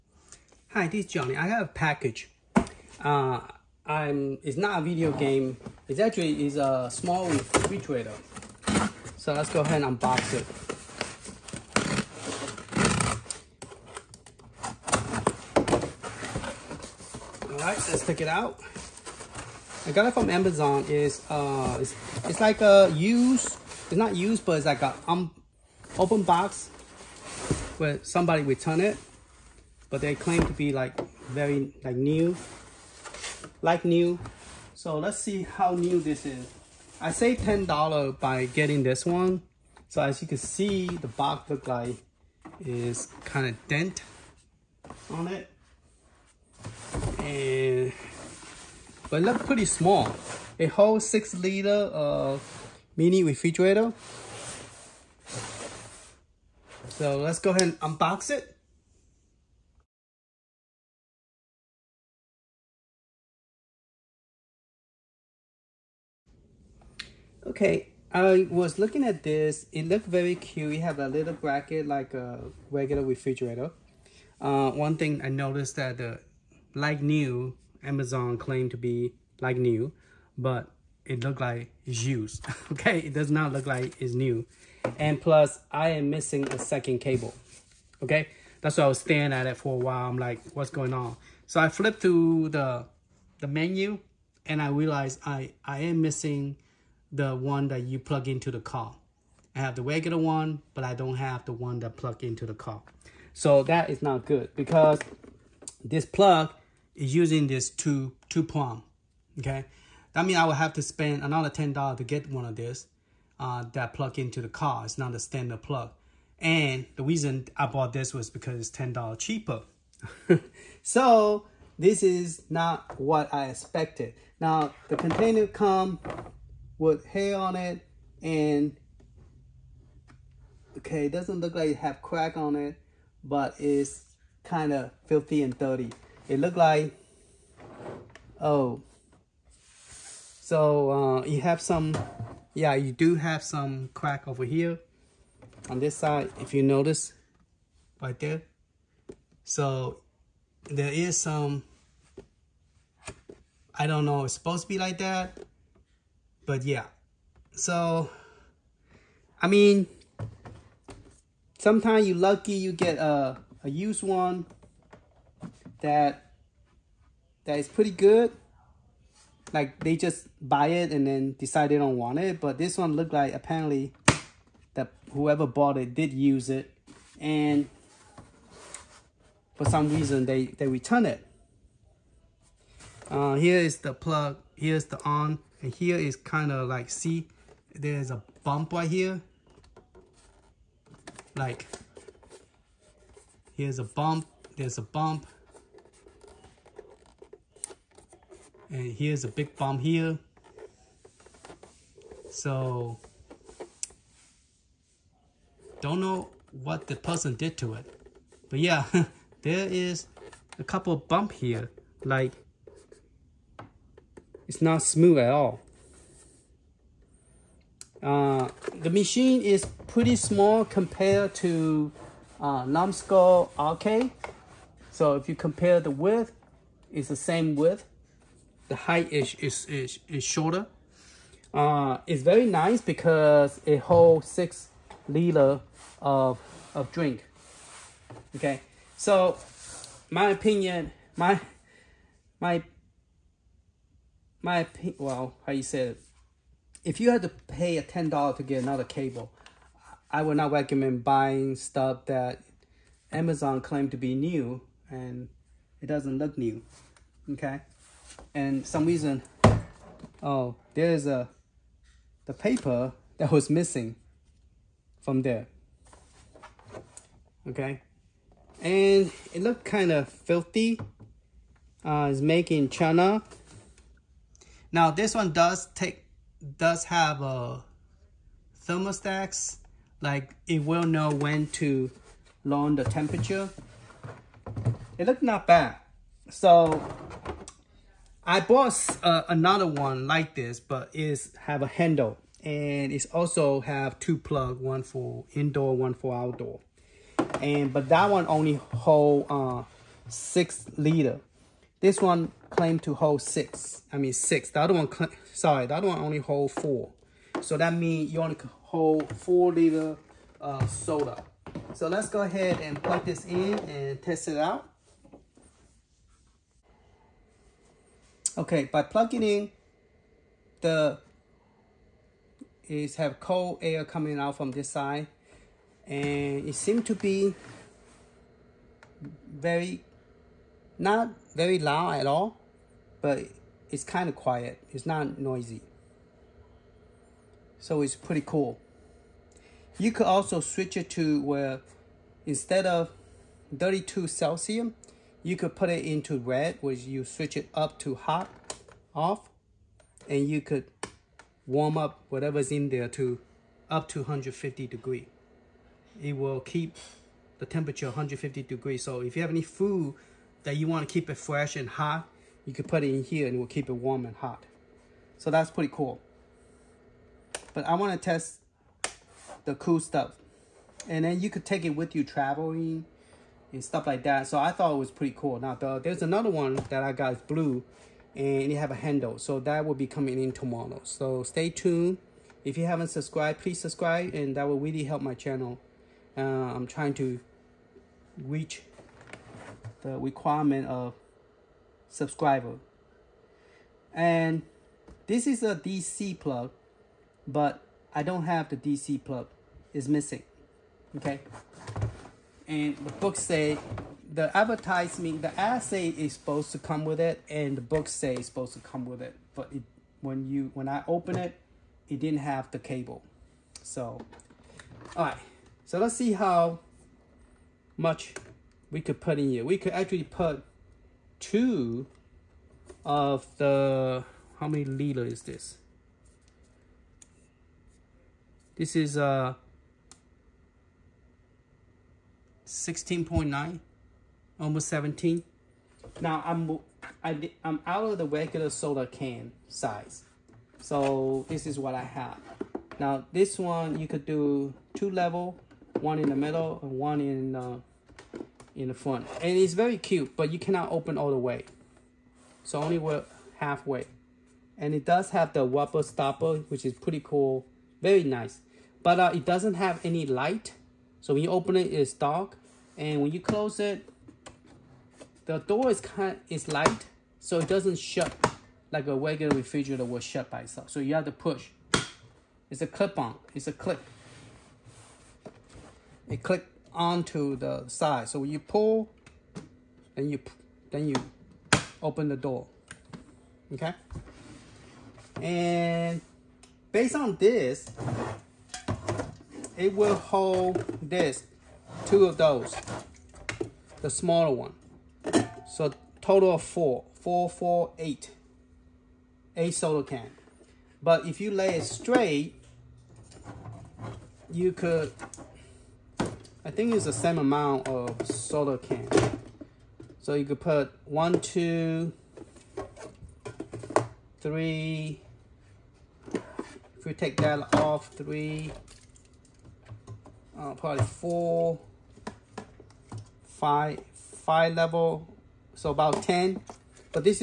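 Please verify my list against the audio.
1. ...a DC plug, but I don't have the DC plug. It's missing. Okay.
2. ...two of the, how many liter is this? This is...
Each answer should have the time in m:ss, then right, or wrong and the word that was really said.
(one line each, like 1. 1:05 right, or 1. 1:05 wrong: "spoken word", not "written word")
1. 6:35 right
2. 7:01 right.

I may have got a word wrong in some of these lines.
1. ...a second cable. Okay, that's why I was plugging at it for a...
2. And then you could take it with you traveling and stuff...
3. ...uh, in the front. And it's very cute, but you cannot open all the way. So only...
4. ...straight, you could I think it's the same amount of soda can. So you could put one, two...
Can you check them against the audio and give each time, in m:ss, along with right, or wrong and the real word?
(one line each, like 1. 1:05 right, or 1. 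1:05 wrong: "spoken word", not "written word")
1. 1:26 wrong: "staring", not "plugging"
2. 6:10 right
3. 7:27 right
4. 8:21 right.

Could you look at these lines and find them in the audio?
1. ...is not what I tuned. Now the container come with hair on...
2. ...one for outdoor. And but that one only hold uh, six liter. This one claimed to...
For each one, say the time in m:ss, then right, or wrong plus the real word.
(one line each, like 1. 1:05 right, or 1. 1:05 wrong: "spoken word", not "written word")
1. 2:02 wrong: "expected", not "tuned"
2. 4:55 right.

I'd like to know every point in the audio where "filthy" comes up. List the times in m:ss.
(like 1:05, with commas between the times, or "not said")
2:15, 4:30.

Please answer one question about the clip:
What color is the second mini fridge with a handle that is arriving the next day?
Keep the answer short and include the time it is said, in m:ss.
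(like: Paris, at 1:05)
blue, at 6:17.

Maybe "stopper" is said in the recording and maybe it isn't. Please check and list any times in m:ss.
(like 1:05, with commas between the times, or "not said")
7:35.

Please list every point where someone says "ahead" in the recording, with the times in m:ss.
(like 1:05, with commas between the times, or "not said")
0:09, 0:57, 5:12.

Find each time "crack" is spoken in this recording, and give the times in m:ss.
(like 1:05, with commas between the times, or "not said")
2:12, 2:23.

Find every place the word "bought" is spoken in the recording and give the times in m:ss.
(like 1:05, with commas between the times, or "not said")
1:57, 2:55, 4:48.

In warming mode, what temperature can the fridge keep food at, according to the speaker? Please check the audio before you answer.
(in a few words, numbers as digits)
150 degrees.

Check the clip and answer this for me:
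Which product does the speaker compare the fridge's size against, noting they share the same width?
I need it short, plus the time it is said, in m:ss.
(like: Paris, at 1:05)
Numskull Arcade, at 3:42.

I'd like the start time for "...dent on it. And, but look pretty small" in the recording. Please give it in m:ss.
0:43.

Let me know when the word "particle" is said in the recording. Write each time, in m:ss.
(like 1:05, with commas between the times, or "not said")
not said.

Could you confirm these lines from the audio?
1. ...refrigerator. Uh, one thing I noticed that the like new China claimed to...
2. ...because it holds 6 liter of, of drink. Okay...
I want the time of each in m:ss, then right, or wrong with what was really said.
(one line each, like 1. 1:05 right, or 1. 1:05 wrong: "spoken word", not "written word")
1. 1:13 wrong: "Amazon", not "China"
2. 3:52 right.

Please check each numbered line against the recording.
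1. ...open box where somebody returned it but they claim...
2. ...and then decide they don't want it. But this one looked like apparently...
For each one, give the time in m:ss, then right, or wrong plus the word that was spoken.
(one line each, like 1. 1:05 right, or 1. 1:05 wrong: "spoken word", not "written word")
1. 0:25 right
2. 2:50 right.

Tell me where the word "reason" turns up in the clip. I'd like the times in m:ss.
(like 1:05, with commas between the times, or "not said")
1:57, 2:59, 4:18.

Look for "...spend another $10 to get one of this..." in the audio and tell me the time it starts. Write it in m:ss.
1:50.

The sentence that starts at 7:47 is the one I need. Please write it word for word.
So it doesn't shut like a regular refrigerator will shut by itself.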